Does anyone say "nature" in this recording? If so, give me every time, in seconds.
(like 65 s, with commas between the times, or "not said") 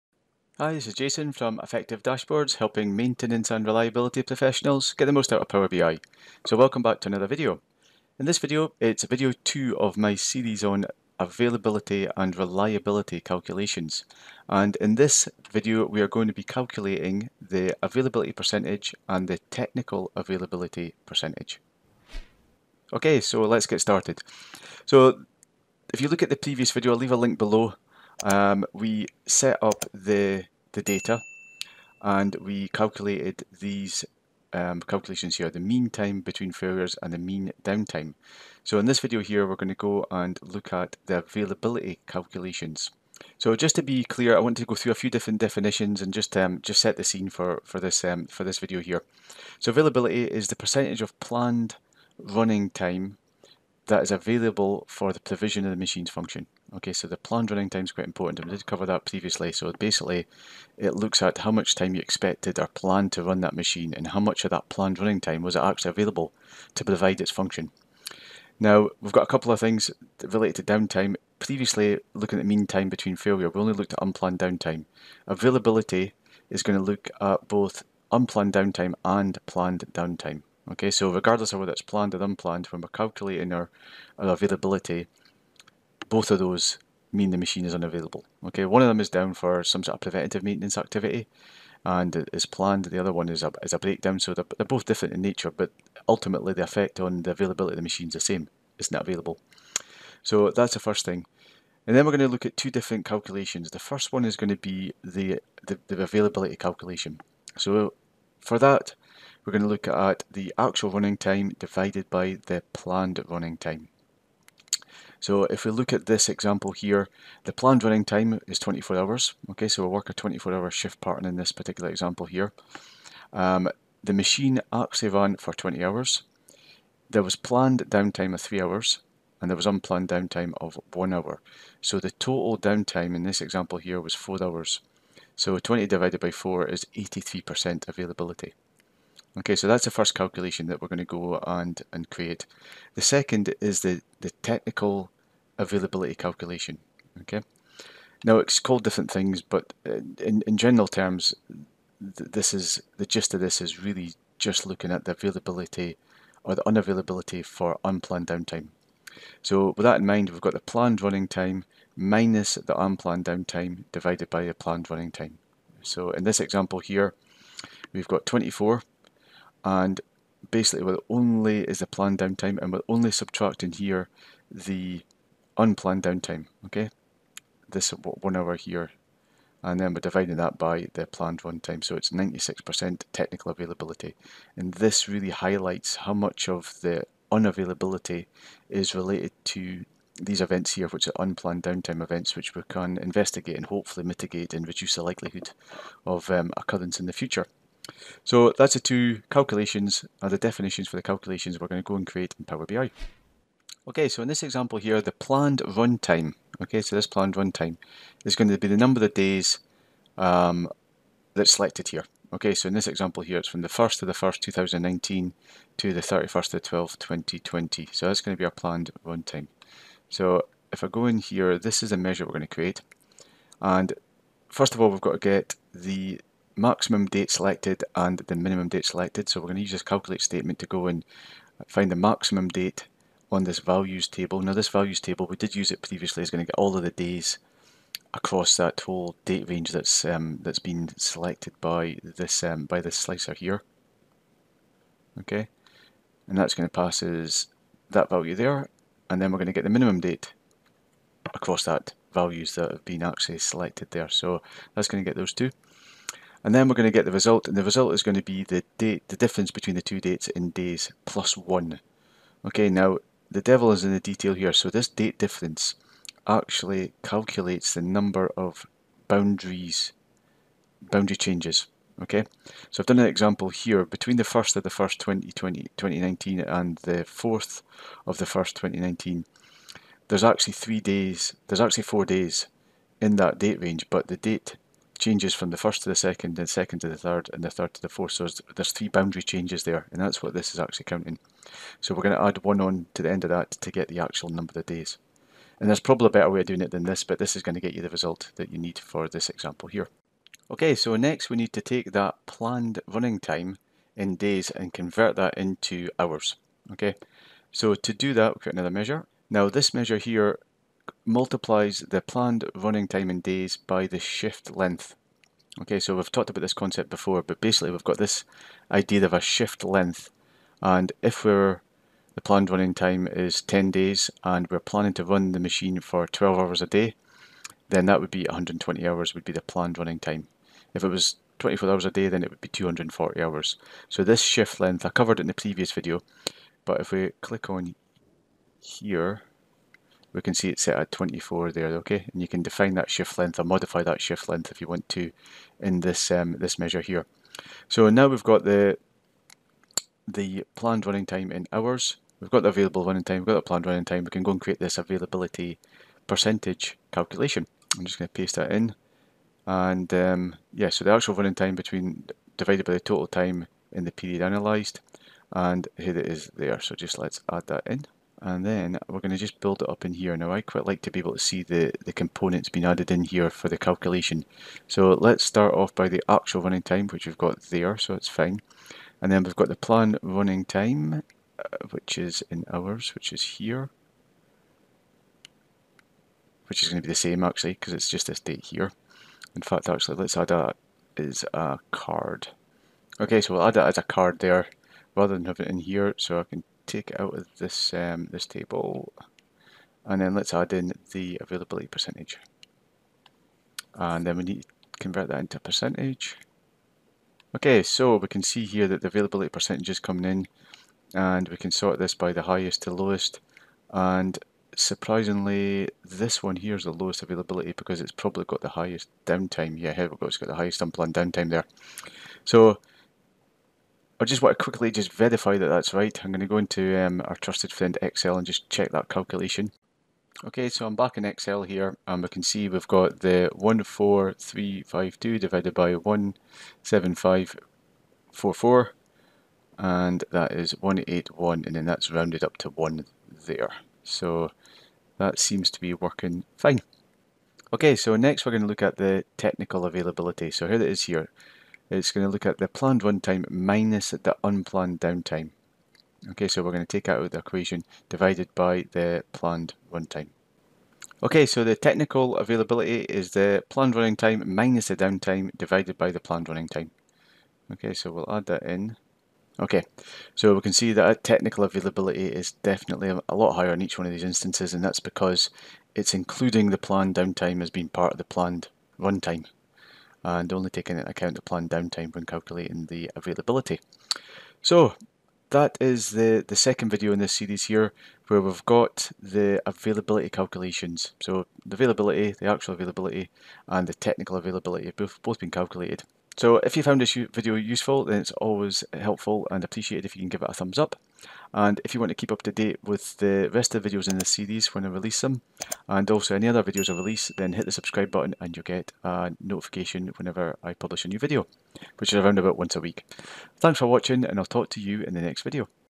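95 s.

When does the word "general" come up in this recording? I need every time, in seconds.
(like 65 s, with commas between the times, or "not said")
150 s.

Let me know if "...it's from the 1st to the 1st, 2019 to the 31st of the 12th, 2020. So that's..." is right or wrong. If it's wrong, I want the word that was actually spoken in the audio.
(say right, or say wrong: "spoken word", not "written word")
right.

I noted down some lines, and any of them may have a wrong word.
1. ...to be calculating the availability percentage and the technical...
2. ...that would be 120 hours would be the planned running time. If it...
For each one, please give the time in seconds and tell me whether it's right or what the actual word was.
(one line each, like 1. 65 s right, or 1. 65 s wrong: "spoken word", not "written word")
1. 16 s right
2. 327 s right.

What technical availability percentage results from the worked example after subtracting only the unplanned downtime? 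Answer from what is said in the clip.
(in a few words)
96%.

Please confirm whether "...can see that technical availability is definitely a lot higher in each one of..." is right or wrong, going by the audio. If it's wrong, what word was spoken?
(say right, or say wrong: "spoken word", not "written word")
right.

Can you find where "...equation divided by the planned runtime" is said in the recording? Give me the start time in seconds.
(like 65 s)
457 s.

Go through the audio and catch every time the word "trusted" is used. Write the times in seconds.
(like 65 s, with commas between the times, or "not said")
427 s.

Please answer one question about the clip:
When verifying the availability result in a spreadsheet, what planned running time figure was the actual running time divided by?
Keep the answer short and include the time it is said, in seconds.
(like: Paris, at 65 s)
17544, at 436 s.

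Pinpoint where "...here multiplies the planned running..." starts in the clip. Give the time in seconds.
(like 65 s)
309 s.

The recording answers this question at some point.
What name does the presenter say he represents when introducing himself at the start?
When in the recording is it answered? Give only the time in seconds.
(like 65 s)
1 s.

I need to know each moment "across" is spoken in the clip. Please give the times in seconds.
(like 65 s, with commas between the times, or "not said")
238 s, 251 s.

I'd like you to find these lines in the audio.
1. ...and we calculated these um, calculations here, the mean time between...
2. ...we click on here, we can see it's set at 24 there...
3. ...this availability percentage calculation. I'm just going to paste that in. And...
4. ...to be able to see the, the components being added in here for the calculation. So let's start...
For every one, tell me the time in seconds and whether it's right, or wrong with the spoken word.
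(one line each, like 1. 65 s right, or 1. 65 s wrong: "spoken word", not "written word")
1. 32 s right
2. 336 s right
3. 354 s right
4. 370 s right.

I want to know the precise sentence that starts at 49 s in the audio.
So availability is the percentage of planned running time that is available for the provision of the machine's function.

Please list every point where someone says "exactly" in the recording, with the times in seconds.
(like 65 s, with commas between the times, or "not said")
not said.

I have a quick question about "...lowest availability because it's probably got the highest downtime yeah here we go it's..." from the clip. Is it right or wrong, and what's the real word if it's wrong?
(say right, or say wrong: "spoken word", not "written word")
right.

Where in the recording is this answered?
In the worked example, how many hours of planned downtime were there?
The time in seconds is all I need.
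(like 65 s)
128 s.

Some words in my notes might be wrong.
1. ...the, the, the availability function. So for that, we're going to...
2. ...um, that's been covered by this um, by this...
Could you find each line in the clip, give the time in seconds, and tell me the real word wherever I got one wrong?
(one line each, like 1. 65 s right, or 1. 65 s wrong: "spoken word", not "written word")
1. 105 s wrong: "calculation", not "function"
2. 240 s wrong: "selected", not "covered".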